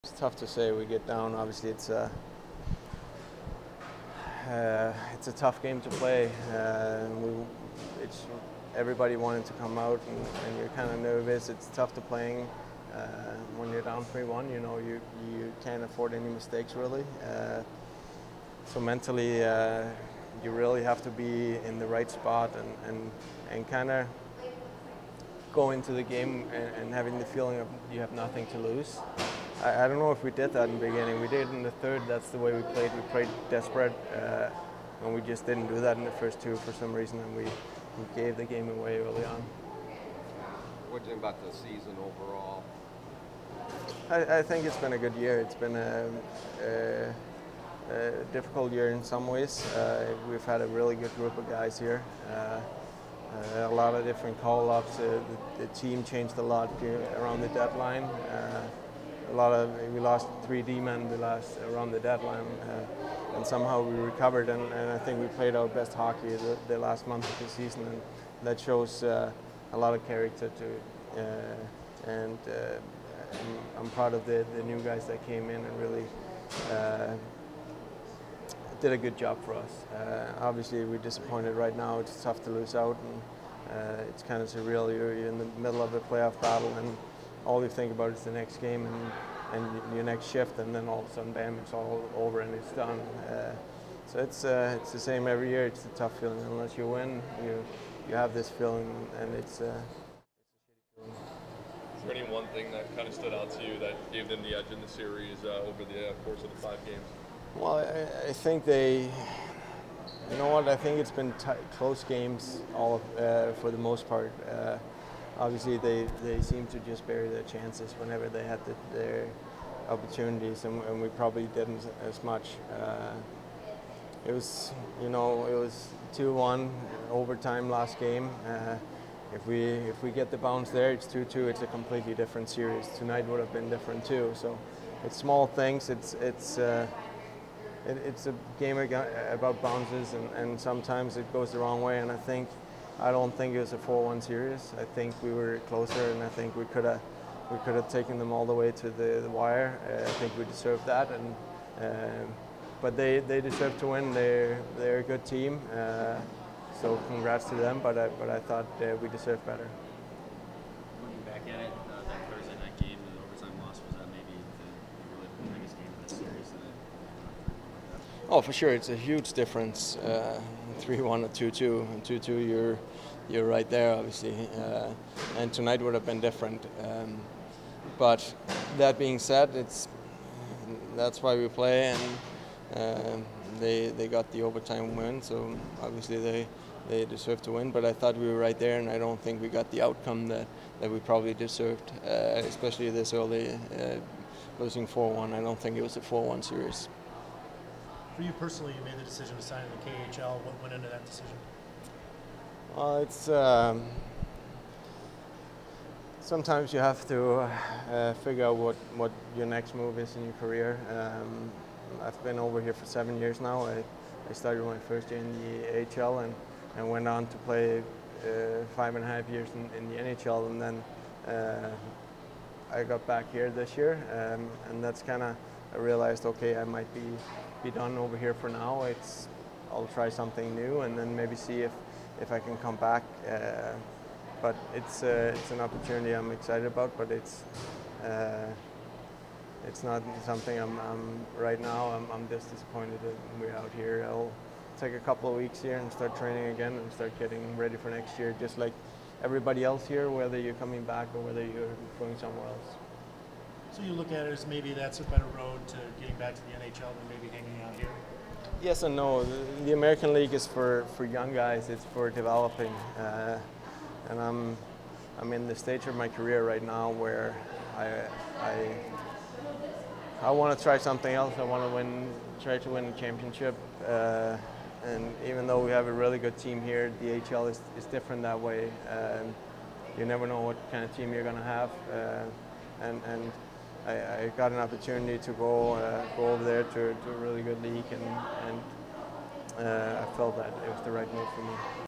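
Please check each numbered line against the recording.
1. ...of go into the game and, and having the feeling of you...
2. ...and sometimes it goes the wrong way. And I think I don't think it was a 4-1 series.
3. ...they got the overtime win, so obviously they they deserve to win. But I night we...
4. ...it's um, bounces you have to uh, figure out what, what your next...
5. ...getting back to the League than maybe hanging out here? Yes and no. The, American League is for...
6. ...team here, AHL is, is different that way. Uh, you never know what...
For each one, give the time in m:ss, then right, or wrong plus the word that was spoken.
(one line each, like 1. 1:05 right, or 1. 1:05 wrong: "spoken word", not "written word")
1. 0:23 right
2. 2:20 right
3. 3:03 wrong: "thought", not "night"
4. 3:23 wrong: "sometimes", not "bounces"
5. 4:16 wrong: "NHL", not "League"
6. 4:36 right.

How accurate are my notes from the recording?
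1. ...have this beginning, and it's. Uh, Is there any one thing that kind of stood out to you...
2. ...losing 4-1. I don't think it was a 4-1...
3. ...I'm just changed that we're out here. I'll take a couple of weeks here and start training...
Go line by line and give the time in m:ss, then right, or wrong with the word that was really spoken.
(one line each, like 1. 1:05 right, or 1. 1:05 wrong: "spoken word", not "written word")
1. 1:38 wrong: "feeling", not "beginning"
2. 3:14 right
3. 4:02 wrong: "disappointed", not "changed".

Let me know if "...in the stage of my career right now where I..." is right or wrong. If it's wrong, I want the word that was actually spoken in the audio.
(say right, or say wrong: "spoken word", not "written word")
right.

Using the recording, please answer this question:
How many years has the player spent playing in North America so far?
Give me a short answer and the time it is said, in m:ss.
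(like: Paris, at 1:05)
7, at 3:32.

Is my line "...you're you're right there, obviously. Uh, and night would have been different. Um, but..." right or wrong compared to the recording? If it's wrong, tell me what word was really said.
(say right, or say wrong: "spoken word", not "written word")
wrong: "tonight", not "night".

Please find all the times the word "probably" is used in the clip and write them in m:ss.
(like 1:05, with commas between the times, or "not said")
2:01, 3:10.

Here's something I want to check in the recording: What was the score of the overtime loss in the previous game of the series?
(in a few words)
2-1.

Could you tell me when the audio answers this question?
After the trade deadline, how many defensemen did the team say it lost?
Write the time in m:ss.
1:00.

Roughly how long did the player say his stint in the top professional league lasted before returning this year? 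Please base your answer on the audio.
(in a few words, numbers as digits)
5 and a half years.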